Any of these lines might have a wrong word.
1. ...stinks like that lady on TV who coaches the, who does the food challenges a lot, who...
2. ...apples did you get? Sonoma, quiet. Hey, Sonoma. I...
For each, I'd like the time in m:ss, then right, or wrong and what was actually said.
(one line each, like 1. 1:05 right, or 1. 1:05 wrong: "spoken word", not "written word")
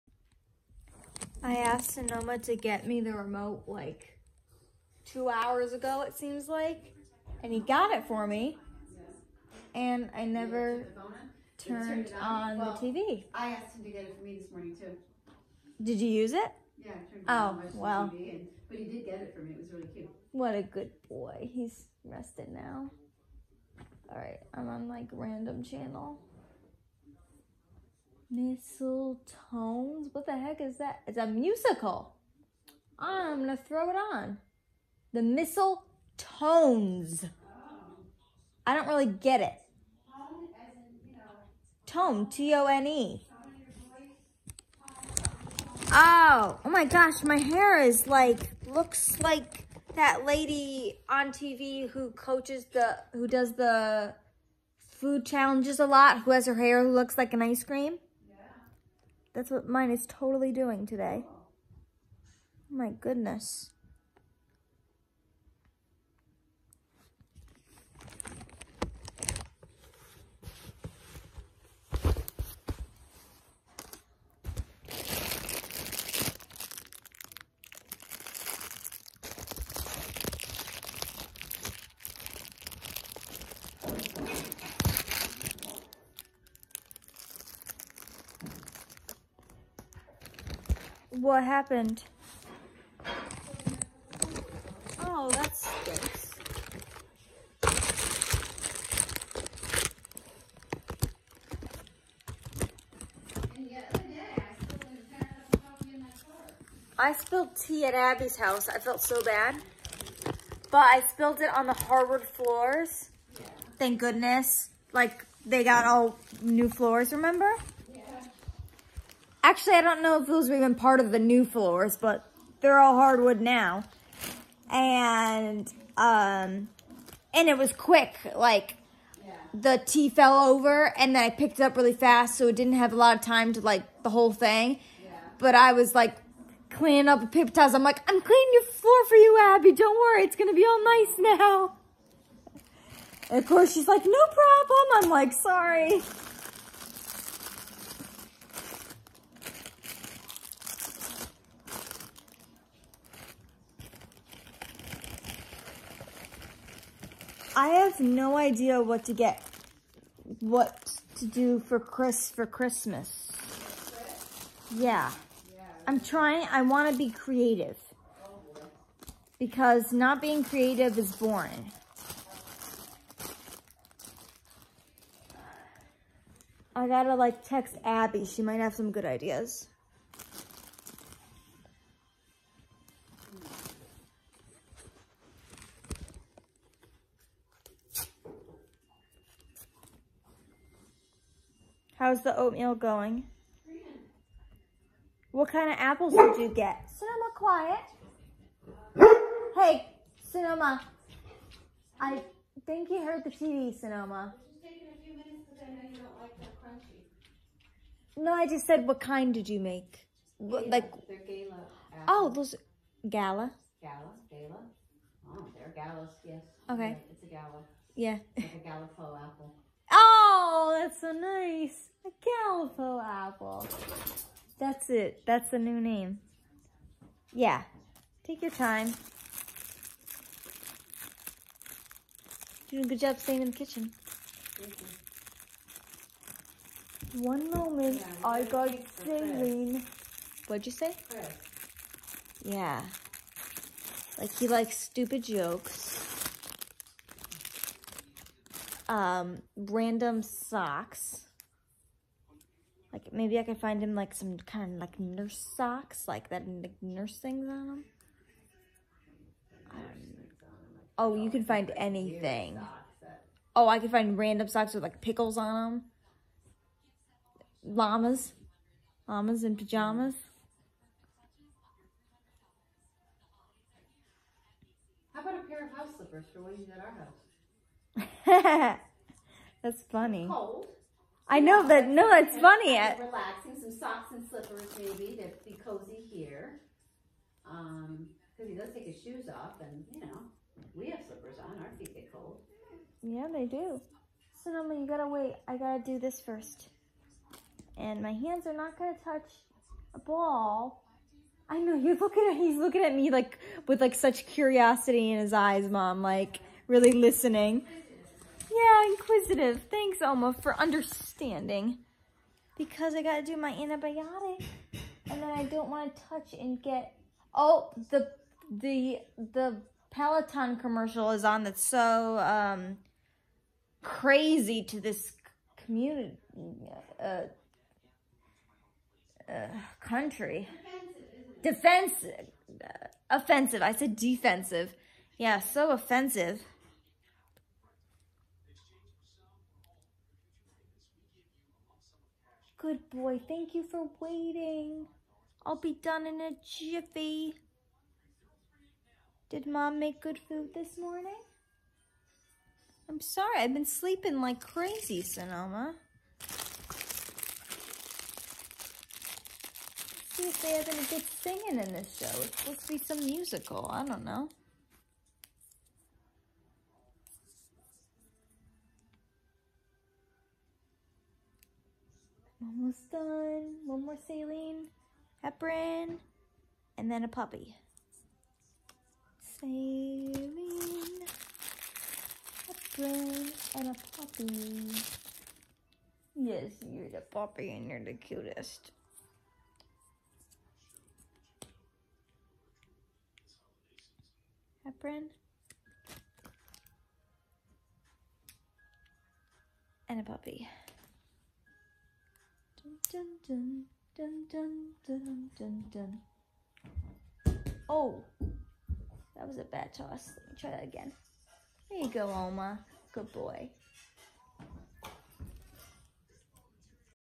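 1. 0:48 wrong: "looks", not "stinks"
2. 3:15 right.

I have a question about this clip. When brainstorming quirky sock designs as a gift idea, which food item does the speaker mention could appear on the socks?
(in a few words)
Pickles.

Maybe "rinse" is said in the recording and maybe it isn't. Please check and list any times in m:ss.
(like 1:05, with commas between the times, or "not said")
not said.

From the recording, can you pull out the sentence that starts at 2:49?
Because not being creative is boring.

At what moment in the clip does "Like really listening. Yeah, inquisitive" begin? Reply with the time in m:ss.
5:06.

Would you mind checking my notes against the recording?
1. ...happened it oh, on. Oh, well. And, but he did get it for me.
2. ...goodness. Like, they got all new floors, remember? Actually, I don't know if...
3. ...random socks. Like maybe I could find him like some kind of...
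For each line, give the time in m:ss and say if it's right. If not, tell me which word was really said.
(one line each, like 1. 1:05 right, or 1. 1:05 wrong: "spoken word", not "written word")
1. 0:16 wrong: "turned", not "happened"
2. 1:53 right
3. 4:09 right.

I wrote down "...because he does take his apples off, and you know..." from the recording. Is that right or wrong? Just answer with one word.
wrong.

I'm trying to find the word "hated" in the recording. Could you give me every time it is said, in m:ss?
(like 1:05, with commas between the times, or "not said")
not said.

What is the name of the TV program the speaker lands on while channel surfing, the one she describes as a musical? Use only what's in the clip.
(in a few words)
The Mistletones.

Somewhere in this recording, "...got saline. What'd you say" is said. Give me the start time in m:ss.
3:58.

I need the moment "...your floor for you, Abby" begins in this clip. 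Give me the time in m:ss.
2:18.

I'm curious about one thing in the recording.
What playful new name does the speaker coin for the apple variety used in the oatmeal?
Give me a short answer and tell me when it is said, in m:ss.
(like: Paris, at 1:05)
Gallipo apple, at 3:42.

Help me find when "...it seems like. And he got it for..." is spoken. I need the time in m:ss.
0:06.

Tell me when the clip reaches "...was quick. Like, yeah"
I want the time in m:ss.
2:07.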